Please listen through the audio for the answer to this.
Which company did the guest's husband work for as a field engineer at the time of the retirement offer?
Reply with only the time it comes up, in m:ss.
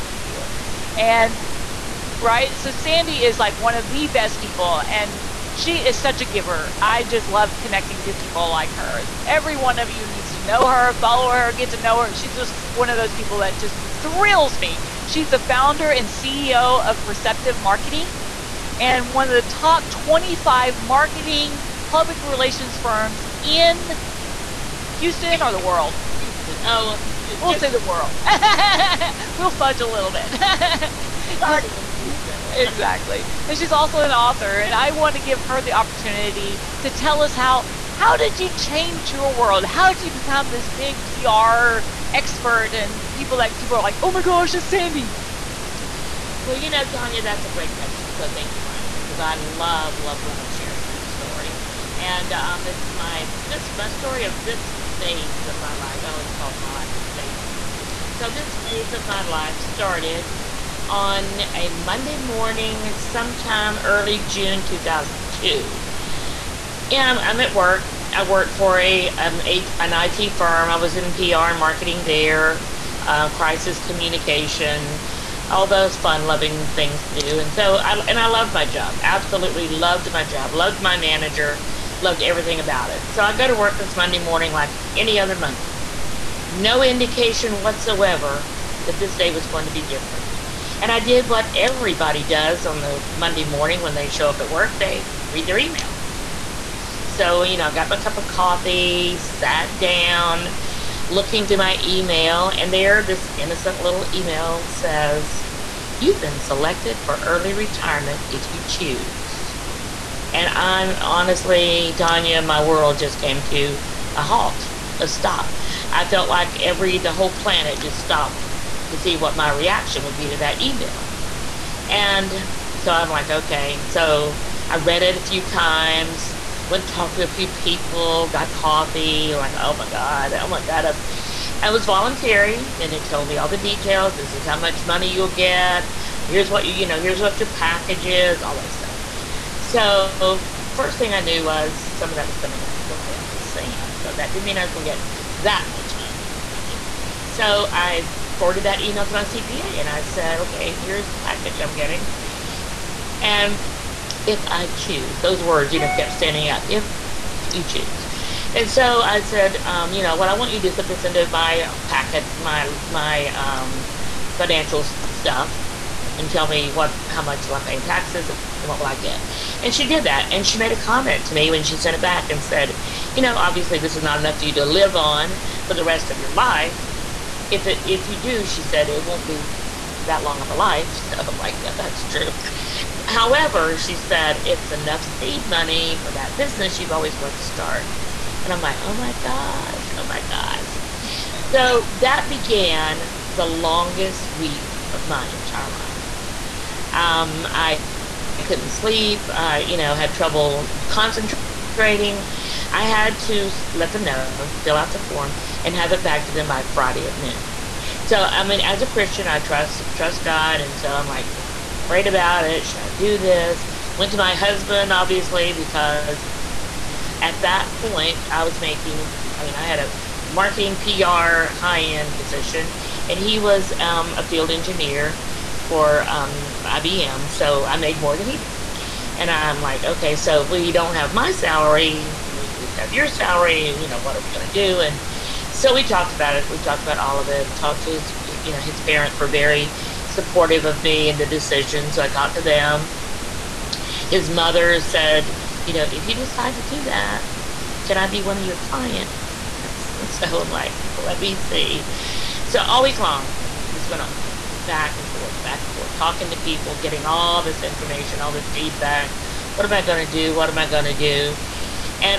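3:46.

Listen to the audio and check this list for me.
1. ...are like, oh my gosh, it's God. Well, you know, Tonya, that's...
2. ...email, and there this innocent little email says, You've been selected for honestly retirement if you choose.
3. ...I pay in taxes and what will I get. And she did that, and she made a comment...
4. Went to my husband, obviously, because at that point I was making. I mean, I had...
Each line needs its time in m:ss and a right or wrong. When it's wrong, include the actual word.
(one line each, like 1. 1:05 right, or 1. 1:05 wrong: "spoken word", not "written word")
1. 0:43 wrong: "Sandy", not "God"
2. 1:41 wrong: "early", not "honestly"
3. 2:47 right
4. 3:33 right.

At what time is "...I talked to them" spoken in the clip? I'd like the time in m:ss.
4:02.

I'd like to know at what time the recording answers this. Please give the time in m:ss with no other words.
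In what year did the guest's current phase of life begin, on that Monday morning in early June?
1:04.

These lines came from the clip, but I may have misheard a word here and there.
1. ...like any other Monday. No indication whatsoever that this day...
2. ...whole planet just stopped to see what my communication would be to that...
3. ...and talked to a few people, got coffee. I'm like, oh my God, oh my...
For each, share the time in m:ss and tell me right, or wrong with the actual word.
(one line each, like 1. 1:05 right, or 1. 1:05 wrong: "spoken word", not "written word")
1. 1:24 right
2. 1:57 wrong: "reaction", not "communication"
3. 2:06 right.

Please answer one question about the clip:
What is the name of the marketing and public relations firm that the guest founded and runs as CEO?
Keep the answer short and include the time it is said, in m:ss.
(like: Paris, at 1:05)
Perceptive Marketing, at 0:17.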